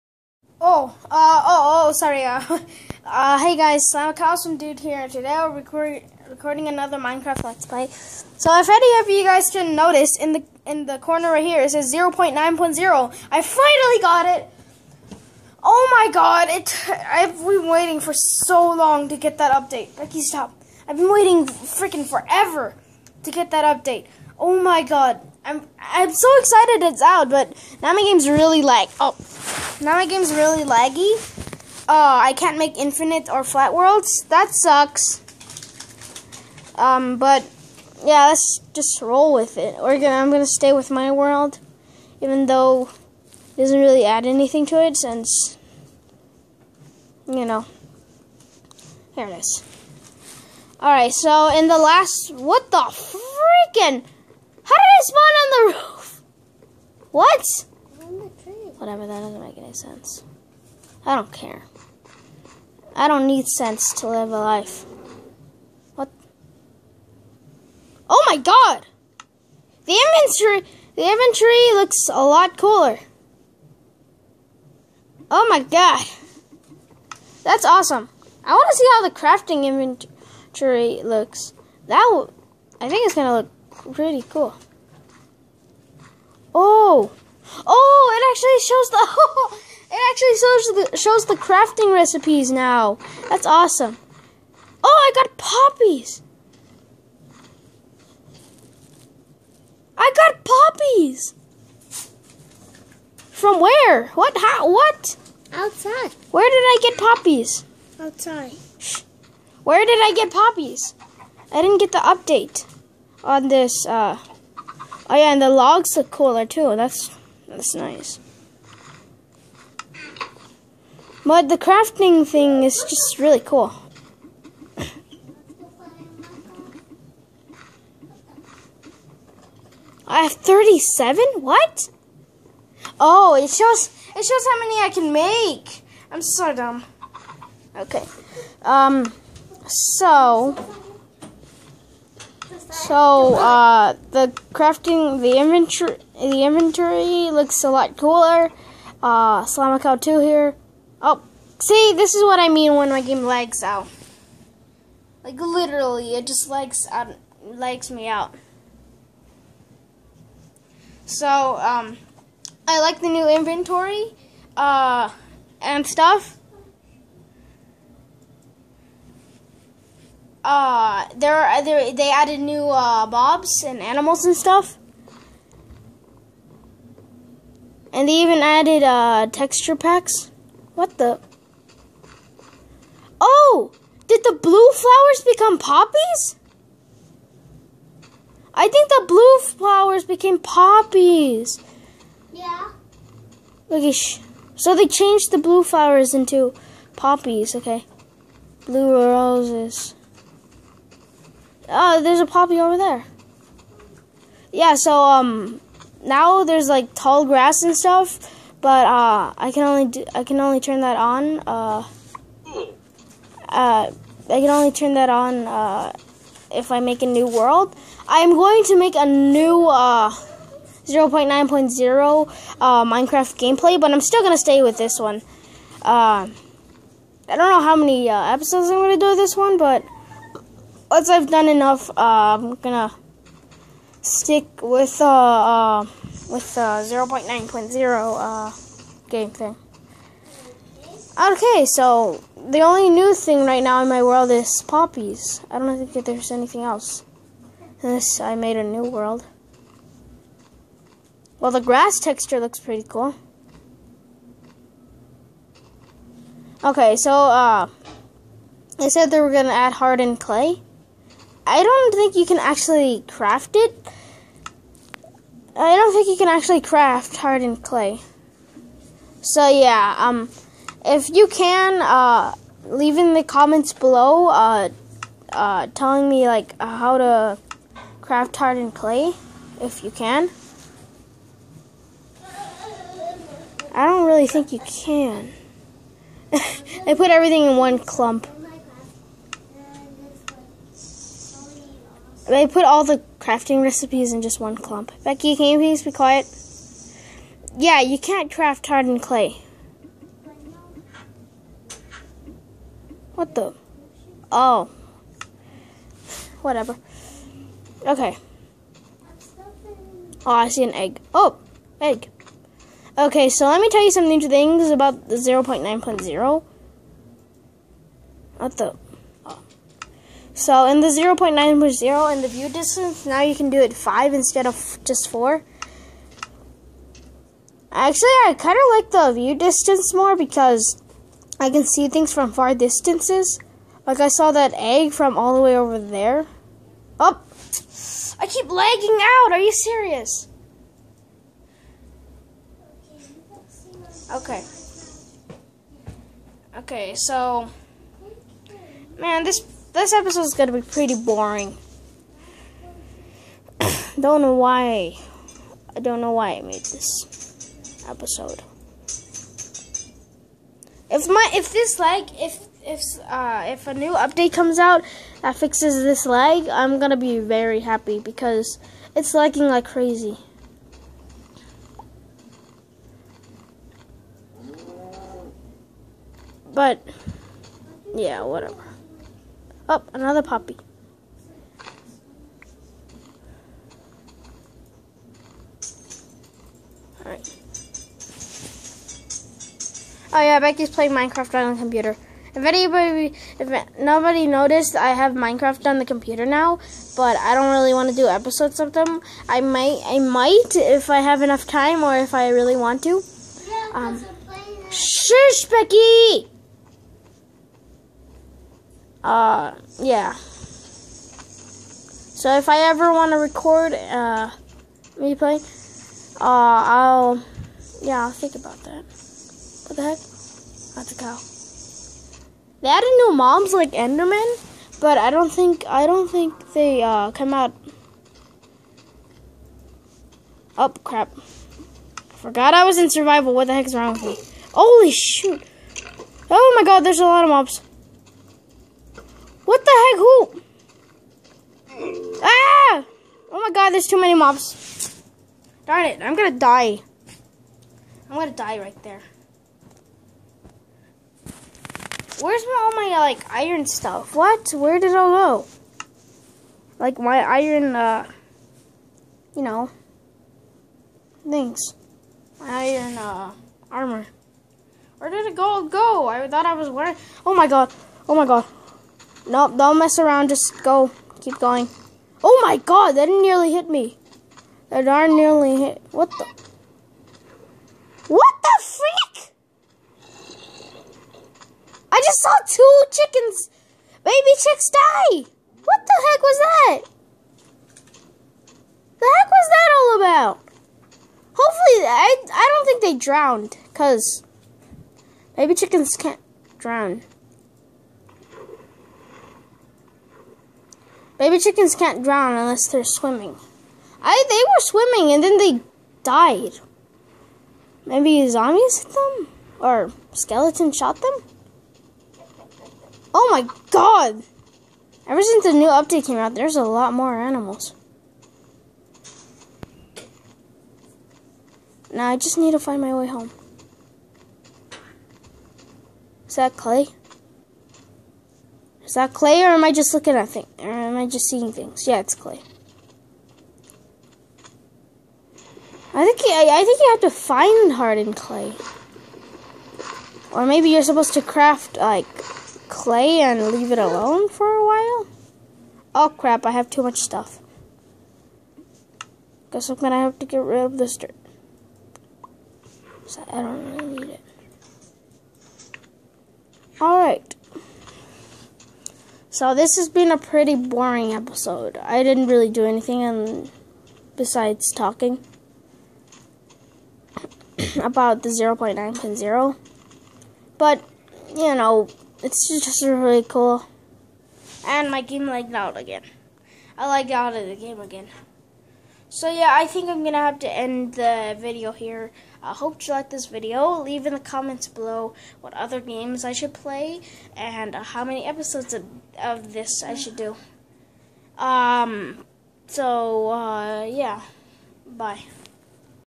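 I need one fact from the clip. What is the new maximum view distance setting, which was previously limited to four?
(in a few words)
5.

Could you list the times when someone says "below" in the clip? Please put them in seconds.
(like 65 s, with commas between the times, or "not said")
273 s, 584 s.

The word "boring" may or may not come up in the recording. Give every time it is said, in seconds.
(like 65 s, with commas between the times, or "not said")
350 s, 560 s.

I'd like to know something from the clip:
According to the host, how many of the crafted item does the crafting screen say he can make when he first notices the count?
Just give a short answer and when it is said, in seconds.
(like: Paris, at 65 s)
37, at 130 s.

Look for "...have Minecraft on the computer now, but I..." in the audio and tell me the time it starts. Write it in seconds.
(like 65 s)
394 s.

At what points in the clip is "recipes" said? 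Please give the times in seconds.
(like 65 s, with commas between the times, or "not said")
91 s, 293 s.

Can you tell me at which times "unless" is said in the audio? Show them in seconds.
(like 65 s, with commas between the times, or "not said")
247 s, 502 s.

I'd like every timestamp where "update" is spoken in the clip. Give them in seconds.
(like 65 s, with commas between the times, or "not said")
19 s, 23 s, 111 s, 363 s, 515 s.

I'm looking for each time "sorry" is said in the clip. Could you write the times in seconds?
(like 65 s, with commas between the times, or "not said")
1 s.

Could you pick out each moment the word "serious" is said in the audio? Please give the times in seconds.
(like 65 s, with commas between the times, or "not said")
339 s.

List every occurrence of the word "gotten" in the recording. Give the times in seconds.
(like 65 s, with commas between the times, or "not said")
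not said.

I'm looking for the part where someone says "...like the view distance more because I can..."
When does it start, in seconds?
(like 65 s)
328 s.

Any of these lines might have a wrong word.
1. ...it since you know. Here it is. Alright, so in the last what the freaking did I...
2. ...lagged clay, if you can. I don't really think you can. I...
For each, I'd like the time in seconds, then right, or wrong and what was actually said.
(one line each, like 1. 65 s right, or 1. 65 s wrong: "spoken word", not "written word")
1. 44 s right
2. 278 s wrong: "hardened", not "lagged".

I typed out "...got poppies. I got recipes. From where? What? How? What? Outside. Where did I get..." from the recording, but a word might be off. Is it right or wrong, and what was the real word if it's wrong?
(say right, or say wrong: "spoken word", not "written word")
wrong: "poppies", not "recipes".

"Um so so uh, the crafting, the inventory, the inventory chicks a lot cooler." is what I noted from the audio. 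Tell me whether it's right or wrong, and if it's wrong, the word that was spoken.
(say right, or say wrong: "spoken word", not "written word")
wrong: "looks", not "chicks".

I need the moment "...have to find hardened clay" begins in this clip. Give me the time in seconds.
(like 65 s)
536 s.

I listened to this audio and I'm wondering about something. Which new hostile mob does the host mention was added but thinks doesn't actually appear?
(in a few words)
Enderman.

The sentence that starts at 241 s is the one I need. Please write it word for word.
Okay, so the only new thing right now in my world is poppies.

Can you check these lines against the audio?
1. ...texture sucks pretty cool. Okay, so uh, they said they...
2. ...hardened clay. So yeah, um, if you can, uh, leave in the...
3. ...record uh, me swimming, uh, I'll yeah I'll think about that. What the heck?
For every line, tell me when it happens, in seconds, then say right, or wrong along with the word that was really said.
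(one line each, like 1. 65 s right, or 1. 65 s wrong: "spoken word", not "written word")
1. 251 s wrong: "looks", not "sucks"
2. 267 s right
3. 413 s wrong: "playing", not "swimming".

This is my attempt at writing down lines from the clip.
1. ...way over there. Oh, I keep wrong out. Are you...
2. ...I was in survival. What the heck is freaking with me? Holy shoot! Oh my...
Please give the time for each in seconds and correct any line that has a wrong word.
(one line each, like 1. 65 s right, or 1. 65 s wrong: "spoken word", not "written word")
1. 335 s wrong: "lagging", not "wrong"
2. 432 s wrong: "wrong", not "freaking".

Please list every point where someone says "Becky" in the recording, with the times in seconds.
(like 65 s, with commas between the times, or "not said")
19 s, 295 s, 390 s, 405 s.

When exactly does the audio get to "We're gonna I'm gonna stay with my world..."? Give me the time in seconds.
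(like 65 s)
39 s.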